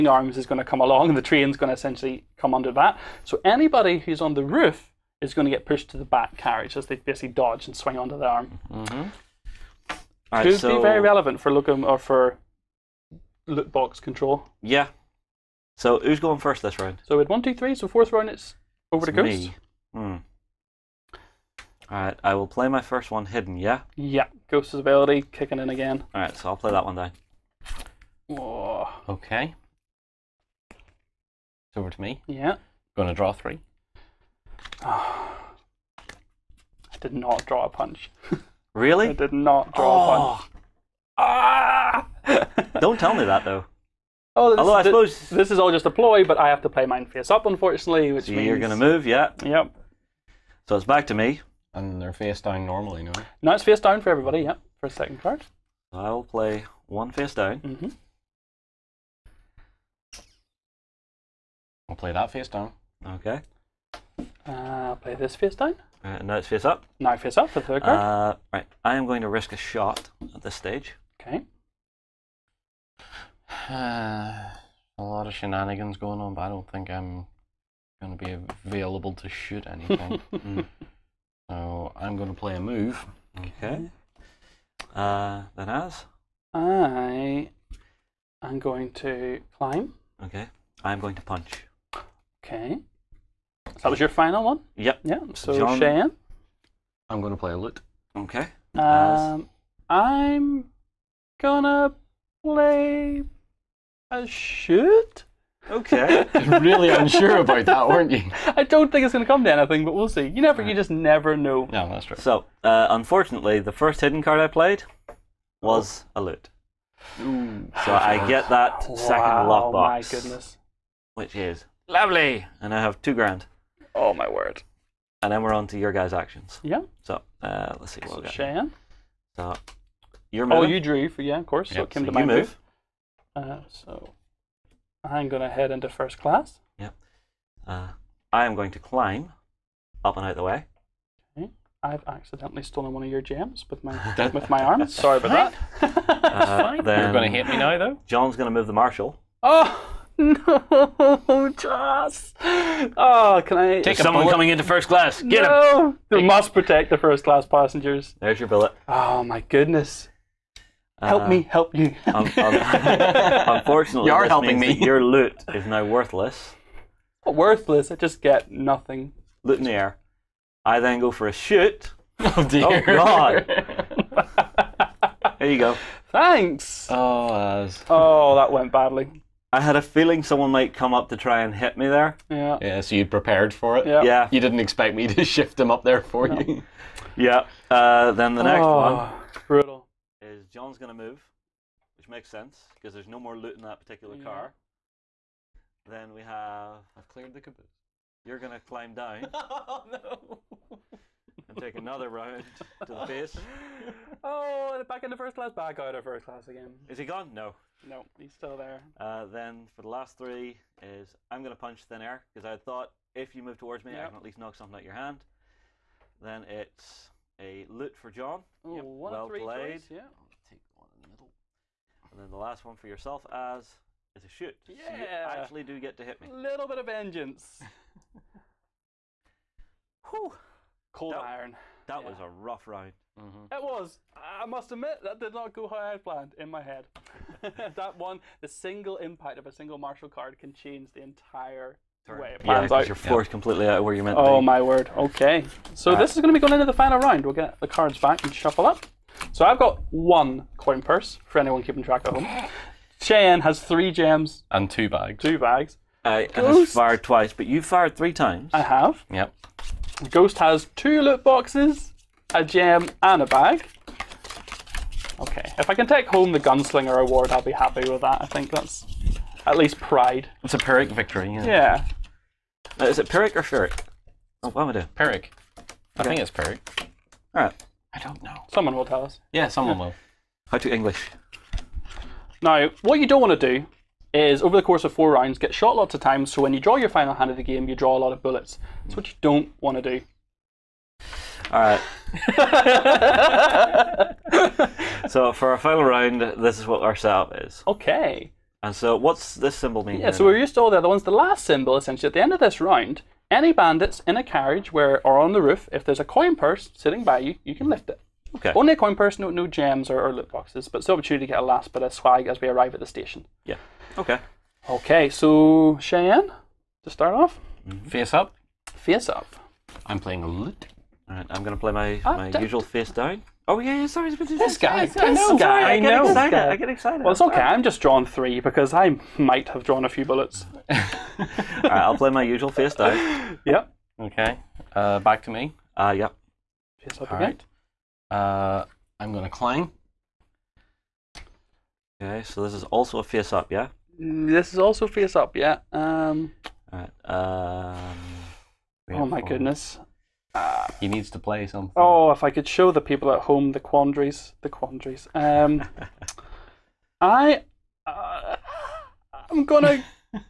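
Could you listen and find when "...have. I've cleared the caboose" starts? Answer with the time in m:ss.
3:16.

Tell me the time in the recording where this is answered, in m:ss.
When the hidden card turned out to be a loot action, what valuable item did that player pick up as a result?
1:59.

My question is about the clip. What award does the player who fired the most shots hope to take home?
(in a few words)
Gunslinger Award.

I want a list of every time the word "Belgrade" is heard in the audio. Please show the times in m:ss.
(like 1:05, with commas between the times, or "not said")
not said.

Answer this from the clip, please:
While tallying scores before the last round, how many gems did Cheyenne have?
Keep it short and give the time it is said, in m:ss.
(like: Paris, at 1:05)
3, at 4:13.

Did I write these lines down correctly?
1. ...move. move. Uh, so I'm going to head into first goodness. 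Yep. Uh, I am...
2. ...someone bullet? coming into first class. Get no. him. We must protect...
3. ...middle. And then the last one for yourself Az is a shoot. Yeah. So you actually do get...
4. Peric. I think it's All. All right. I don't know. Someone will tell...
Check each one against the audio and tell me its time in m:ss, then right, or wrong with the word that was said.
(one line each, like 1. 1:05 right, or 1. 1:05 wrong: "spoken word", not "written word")
1. 2:12 wrong: "class", not "goodness"
2. 2:33 right
3. 3:41 right
4. 4:34 wrong: "Peric", not "All".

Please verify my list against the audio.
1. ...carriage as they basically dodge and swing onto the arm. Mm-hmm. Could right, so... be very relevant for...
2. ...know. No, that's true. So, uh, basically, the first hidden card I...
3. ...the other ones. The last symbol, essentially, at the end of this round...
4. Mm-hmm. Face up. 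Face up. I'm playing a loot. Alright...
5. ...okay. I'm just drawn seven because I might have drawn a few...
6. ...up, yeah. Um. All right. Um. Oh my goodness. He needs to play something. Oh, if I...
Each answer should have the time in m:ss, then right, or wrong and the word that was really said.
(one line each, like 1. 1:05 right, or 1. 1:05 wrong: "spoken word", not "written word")
1. 0:06 right
2. 1:51 wrong: "unfortunately", not "basically"
3. 5:00 right
4. 5:17 right
5. 5:27 wrong: "three", not "seven"
6. 5:45 right.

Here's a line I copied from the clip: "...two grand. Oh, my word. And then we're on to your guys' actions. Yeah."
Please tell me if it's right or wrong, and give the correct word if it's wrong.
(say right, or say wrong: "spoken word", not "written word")
right.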